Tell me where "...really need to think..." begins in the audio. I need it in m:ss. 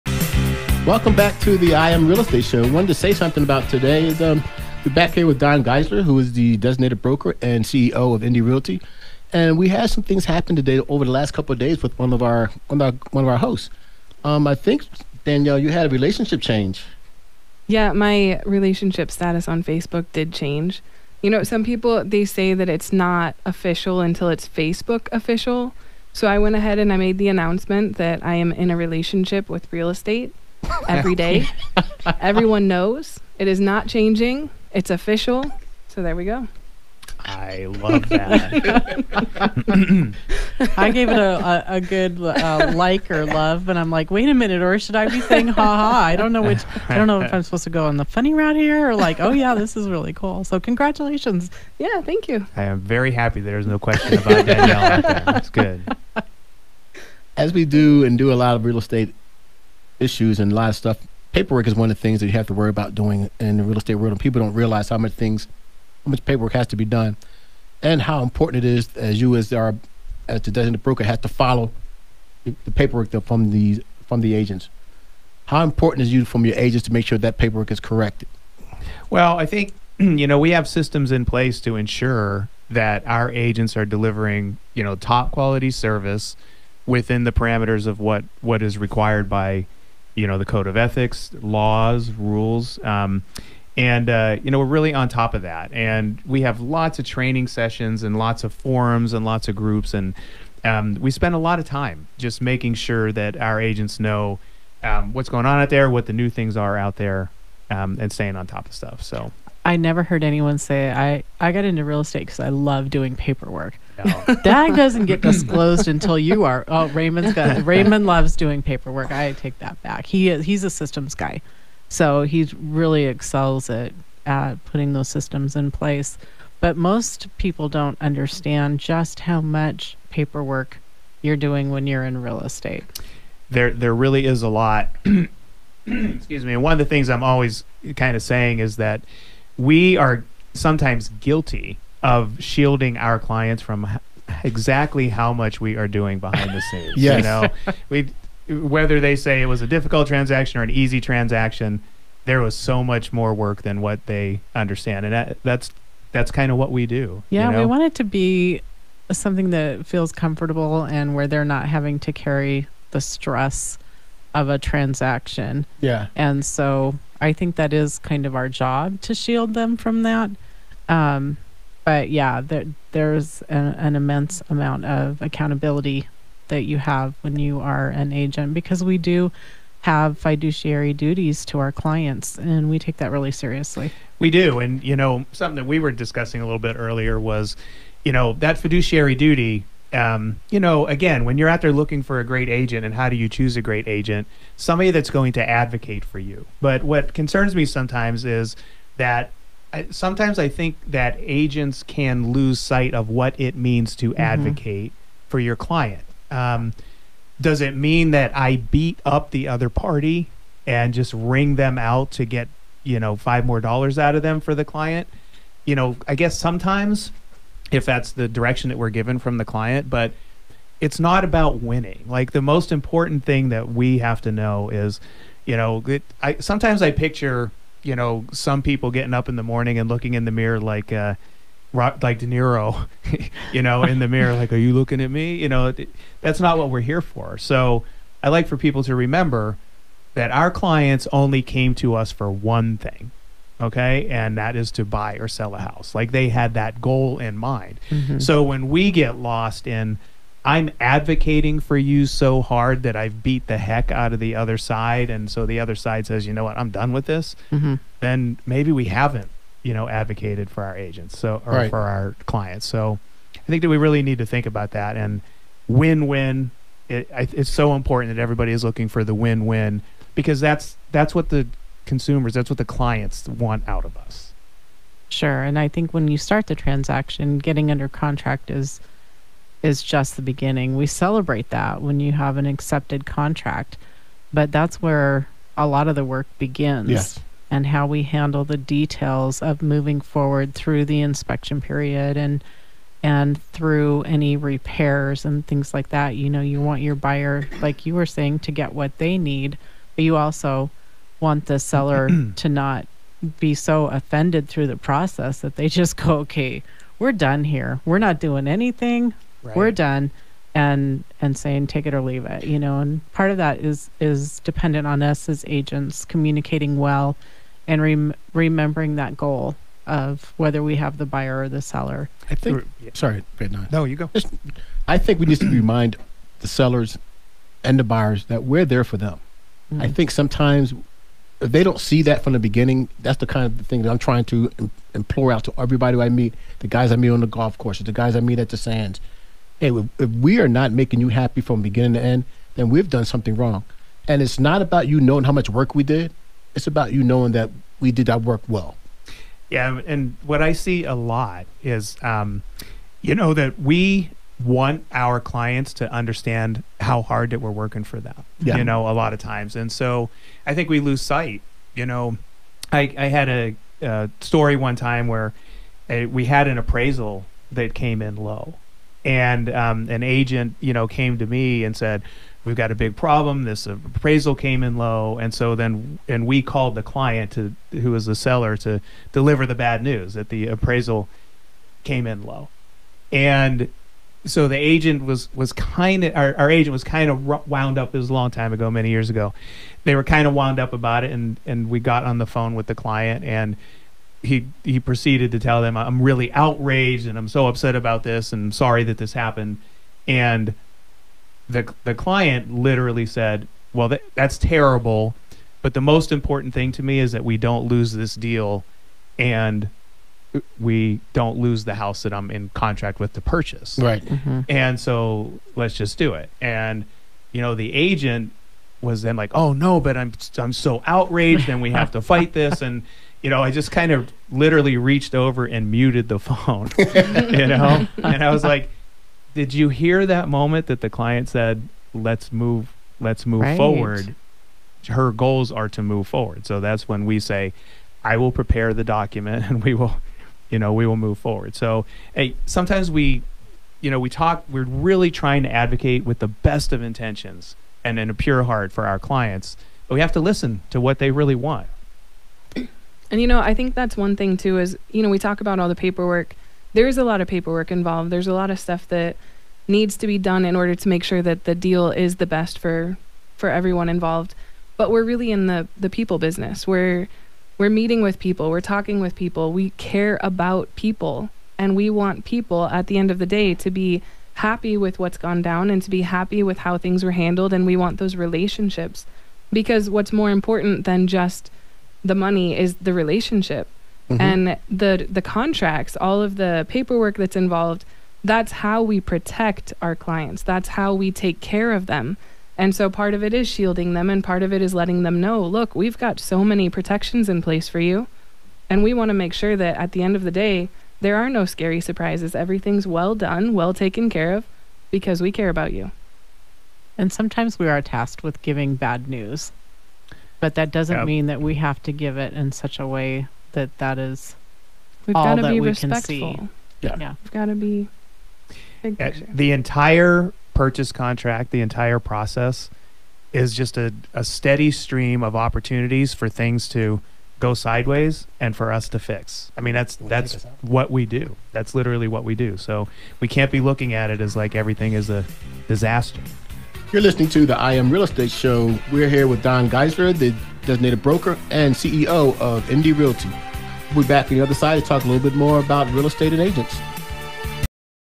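4:23.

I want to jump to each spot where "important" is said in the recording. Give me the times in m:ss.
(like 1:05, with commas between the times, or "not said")
1:08, 1:15, 3:42, 4:27, 6:46, 8:00.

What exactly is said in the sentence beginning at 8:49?
I mean, that's that's what we do.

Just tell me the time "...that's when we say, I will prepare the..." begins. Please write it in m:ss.
7:16.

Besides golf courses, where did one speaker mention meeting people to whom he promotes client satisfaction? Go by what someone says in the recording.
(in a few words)
the Sands.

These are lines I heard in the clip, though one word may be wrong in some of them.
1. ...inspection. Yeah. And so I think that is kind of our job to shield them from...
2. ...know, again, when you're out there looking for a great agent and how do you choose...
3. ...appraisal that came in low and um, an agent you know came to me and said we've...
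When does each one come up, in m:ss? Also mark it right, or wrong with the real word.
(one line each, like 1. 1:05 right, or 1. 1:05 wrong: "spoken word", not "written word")
1. 2:44 wrong: "transaction", not "inspection"
2. 3:10 right
3. 6:06 right.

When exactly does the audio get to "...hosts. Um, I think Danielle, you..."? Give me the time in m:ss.
0:13.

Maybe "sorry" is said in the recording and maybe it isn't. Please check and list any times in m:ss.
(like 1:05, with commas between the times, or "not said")
5:22, 6:38.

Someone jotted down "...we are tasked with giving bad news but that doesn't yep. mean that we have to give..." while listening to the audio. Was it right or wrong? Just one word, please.
right.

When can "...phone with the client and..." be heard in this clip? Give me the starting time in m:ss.
6:32.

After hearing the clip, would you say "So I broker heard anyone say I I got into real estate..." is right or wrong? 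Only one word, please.
wrong.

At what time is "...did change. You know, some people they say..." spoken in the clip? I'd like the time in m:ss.
0:20.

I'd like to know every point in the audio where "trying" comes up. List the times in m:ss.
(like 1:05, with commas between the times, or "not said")
5:33, 7:25.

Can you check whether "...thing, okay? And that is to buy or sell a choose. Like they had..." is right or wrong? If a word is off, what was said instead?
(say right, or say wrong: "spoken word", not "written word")
wrong: "house", not "choose".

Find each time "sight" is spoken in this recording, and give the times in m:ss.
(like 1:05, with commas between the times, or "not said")
3:22, 6:01.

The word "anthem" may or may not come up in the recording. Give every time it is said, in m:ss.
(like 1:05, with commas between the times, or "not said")
not said.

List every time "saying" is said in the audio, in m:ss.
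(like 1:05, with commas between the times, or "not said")
0:45, 2:18, 4:58, 5:11.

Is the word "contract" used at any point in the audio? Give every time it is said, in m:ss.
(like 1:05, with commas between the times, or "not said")
4:37, 4:43, 6:52, 8:05, 8:40.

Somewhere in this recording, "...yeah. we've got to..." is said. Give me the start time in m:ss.
8:36.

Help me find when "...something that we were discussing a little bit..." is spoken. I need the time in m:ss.
3:05.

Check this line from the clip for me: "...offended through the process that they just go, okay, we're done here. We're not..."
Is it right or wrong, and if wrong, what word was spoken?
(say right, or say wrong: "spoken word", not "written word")
right.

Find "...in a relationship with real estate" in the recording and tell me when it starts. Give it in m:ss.
0:28.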